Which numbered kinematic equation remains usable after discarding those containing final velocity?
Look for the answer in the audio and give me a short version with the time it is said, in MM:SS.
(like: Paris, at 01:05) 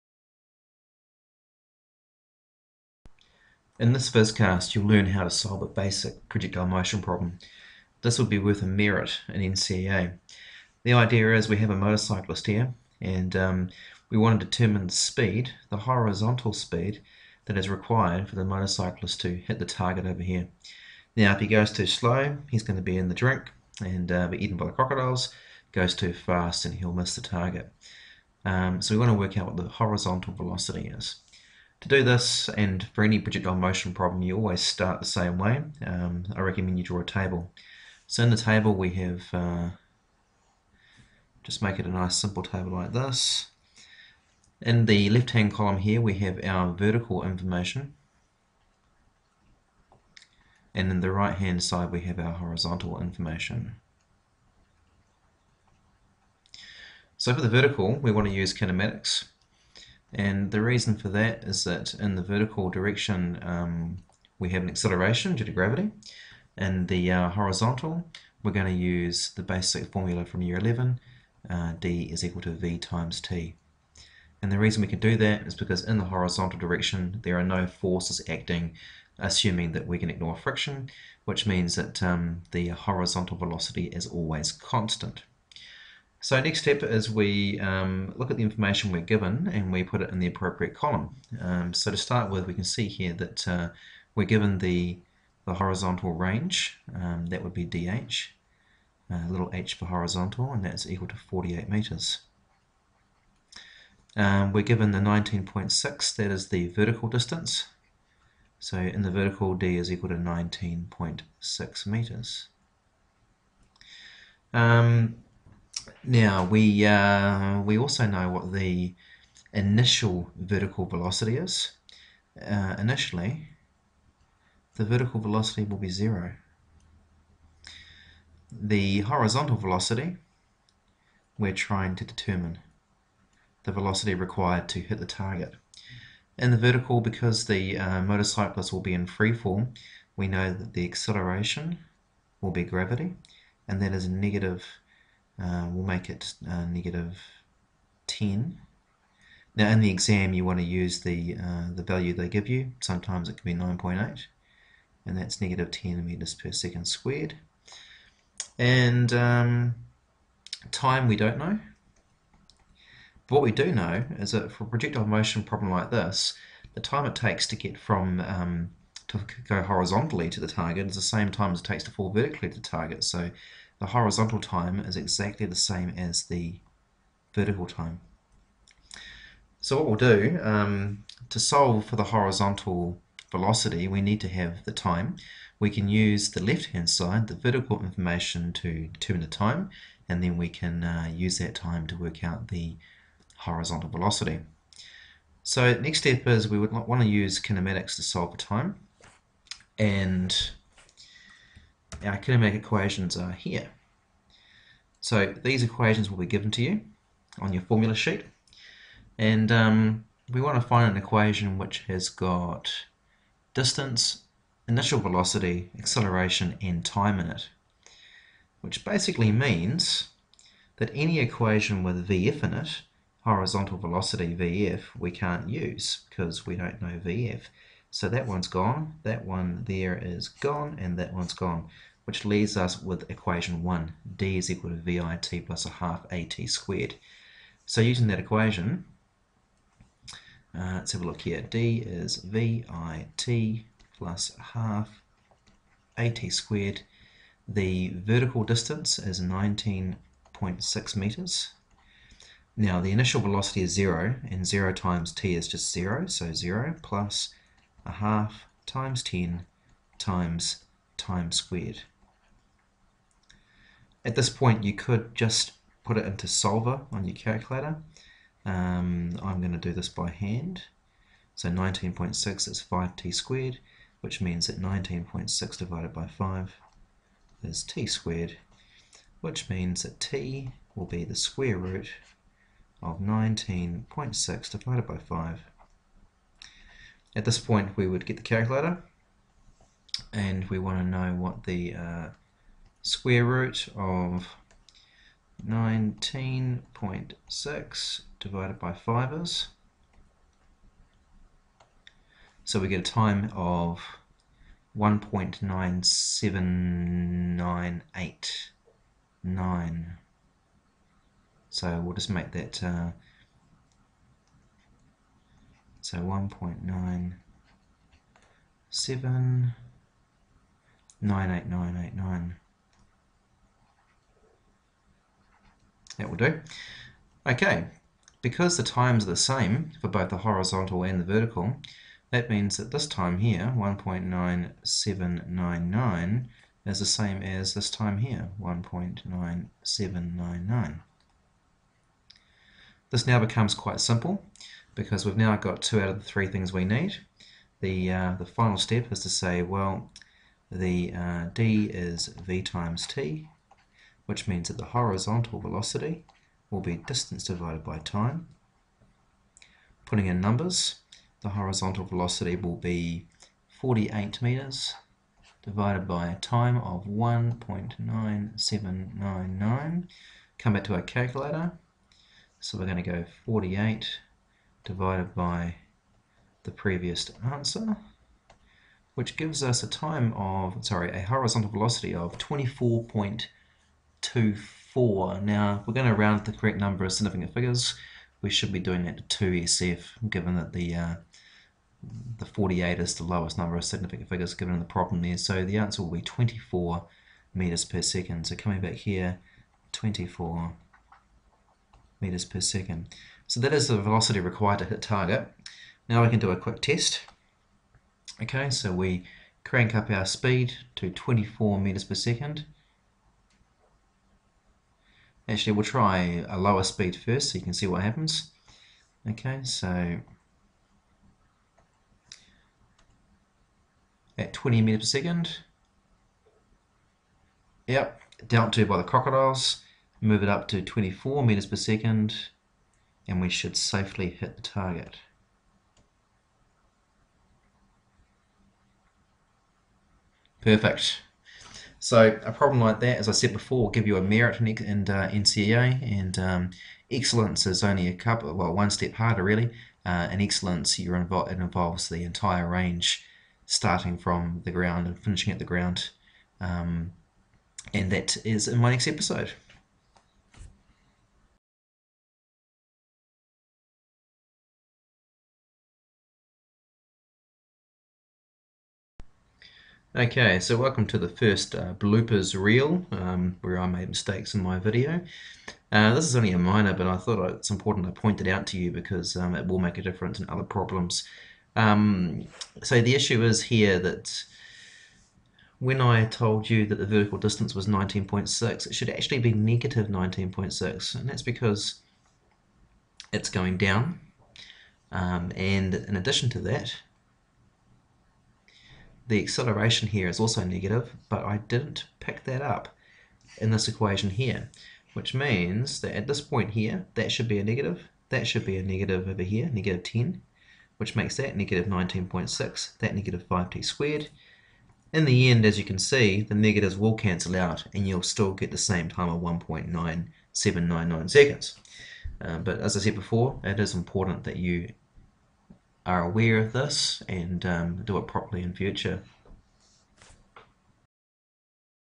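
equation 1, at 03:53.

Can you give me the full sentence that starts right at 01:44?
Um, we're given the 19.6, that is the vertical distance.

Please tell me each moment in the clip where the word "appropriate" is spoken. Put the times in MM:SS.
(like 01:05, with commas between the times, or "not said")
01:30.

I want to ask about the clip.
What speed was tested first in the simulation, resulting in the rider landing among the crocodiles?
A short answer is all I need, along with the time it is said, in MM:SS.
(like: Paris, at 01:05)
20 m/s, at 07:04.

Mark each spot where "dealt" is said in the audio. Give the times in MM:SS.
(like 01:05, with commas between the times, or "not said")
07:08.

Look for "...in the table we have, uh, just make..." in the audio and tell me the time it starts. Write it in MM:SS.
00:38.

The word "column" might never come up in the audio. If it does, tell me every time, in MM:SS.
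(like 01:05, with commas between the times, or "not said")
00:45, 01:30.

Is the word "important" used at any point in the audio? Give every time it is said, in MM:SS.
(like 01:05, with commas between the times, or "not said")
07:57, 08:43.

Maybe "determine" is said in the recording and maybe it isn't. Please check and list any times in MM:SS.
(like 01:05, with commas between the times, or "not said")
00:14, 02:12, 03:08.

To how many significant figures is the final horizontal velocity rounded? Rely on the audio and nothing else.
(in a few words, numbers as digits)
2.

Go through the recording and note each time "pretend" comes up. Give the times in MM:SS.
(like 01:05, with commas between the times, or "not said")
not said.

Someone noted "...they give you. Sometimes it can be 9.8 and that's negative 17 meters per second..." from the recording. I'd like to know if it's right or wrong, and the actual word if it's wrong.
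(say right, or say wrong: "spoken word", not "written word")
wrong: "10", not "17".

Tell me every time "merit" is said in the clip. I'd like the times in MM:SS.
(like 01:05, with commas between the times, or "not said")
00:08, 07:24.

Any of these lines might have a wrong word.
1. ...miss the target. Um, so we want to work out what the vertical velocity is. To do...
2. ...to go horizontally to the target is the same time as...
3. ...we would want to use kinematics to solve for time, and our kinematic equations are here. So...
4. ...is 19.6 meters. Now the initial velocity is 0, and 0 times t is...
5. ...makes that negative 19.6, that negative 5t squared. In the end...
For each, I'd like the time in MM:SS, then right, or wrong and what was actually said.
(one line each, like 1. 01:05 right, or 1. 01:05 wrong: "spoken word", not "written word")
1. 00:26 wrong: "horizontal", not "vertical"
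2. 02:49 right
3. 03:16 right
4. 04:08 right
5. 08:30 right.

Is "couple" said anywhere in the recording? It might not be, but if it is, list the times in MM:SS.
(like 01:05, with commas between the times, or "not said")
07:27.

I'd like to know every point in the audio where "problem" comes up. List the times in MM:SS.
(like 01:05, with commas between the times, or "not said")
00:07, 00:33, 02:45, 06:34, 07:22, 08:00.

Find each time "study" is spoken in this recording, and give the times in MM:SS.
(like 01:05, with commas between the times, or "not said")
not said.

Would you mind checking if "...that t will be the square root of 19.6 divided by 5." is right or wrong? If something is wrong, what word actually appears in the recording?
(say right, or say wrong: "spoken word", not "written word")
right.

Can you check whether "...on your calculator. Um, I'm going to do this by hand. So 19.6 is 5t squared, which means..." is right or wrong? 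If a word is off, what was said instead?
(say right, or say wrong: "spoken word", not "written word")
right.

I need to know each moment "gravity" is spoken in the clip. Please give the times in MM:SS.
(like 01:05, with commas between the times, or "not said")
01:05, 02:22.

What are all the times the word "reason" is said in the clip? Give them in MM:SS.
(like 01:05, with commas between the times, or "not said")
01:00, 01:14.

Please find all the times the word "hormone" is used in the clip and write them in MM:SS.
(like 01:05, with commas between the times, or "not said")
not said.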